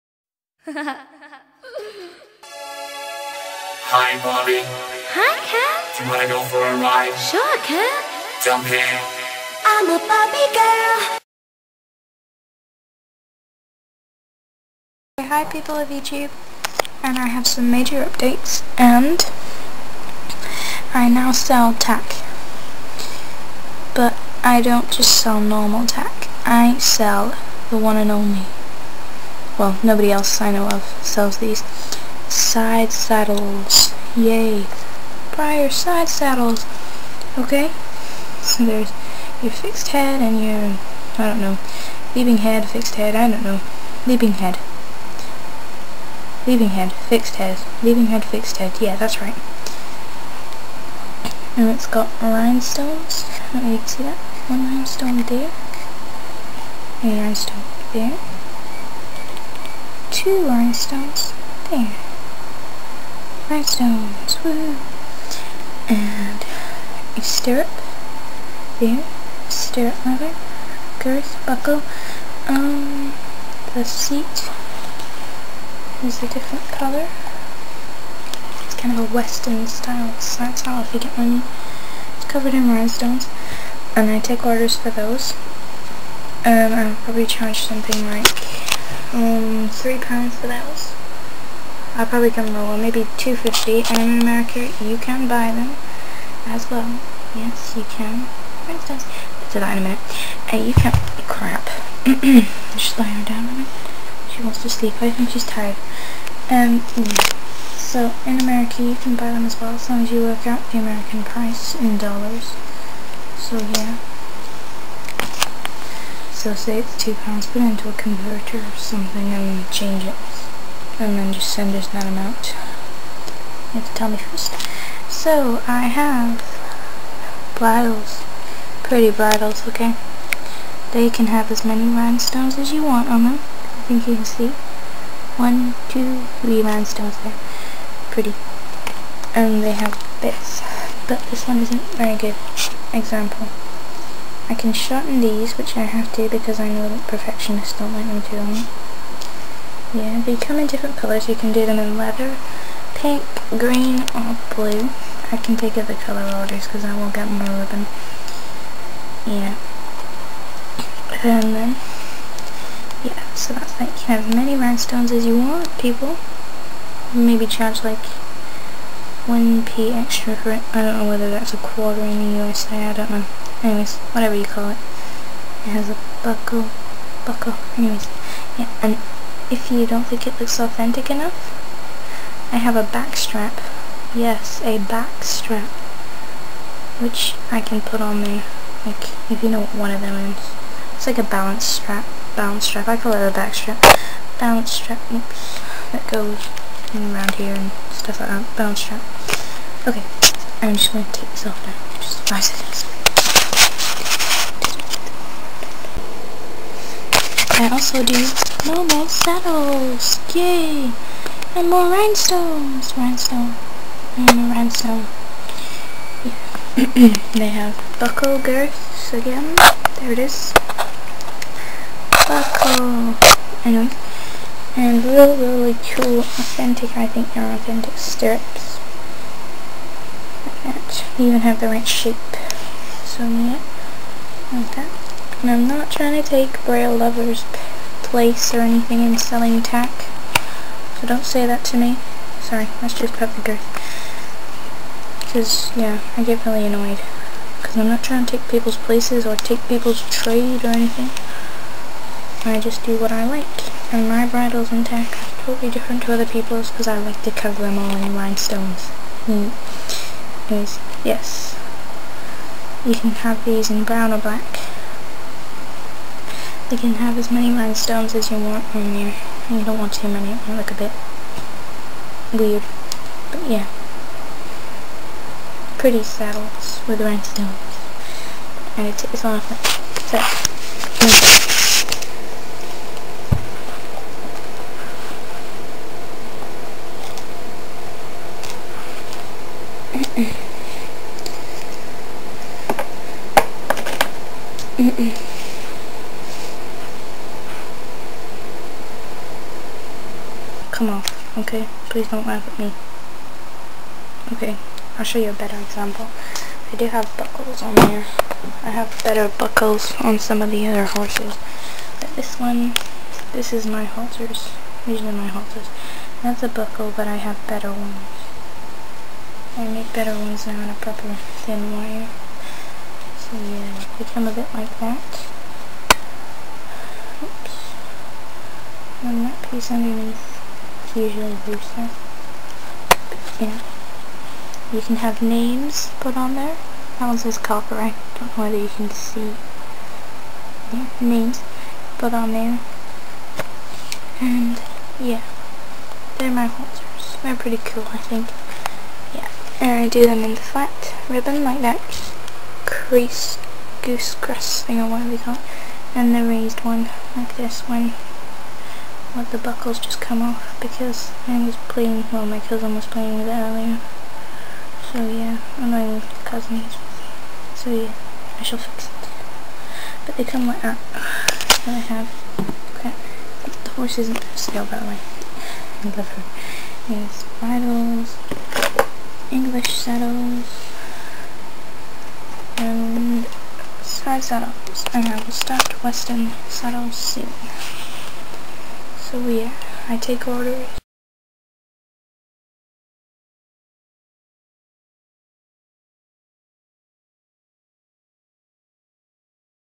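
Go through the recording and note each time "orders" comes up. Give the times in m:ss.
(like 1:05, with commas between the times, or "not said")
1:24, 2:36, 6:30.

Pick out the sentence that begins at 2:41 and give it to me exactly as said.
And then, yeah, so that's like You can have as many rhinestones as you want, people.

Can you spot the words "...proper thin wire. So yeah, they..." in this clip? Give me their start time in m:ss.
5:20.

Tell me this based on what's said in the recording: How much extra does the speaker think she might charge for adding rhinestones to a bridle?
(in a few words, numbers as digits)
1p.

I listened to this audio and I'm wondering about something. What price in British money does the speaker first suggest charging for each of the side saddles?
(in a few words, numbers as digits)
3 pounds.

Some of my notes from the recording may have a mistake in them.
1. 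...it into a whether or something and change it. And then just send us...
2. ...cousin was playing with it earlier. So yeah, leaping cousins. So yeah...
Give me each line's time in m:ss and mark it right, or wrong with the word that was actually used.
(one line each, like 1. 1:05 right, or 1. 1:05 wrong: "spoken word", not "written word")
1. 1:57 wrong: "converter", not "whether"
2. 6:02 wrong: "annoying", not "leaping".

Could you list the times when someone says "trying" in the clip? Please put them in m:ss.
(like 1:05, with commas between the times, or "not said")
3:55, 4:08.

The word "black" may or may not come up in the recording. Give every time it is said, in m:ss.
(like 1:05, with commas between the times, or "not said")
4:24.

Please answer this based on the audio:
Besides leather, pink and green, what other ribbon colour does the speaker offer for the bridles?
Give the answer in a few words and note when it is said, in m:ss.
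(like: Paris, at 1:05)
blue, at 2:34.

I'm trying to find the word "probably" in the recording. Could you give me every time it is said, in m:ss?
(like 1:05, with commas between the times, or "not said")
1:26, 1:32.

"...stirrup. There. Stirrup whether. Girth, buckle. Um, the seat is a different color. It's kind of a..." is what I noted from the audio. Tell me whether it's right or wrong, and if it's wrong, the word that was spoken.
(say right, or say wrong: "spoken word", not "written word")
wrong: "leather", not "whether".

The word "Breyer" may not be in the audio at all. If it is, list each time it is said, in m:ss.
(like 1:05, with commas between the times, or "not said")
0:35, 3:56.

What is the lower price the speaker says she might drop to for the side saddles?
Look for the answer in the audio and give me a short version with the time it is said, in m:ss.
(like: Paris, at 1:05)
2.50, at 1:33.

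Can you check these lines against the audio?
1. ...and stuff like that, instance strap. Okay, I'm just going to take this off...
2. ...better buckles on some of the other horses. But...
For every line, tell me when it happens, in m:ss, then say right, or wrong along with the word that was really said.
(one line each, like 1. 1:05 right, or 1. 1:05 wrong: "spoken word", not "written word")
1. 3:17 wrong: "balance", not "instance"
2. 5:09 right.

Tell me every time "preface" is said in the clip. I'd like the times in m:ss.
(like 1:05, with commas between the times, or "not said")
not said.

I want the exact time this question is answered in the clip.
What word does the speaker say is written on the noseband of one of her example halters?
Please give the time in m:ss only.
5:37.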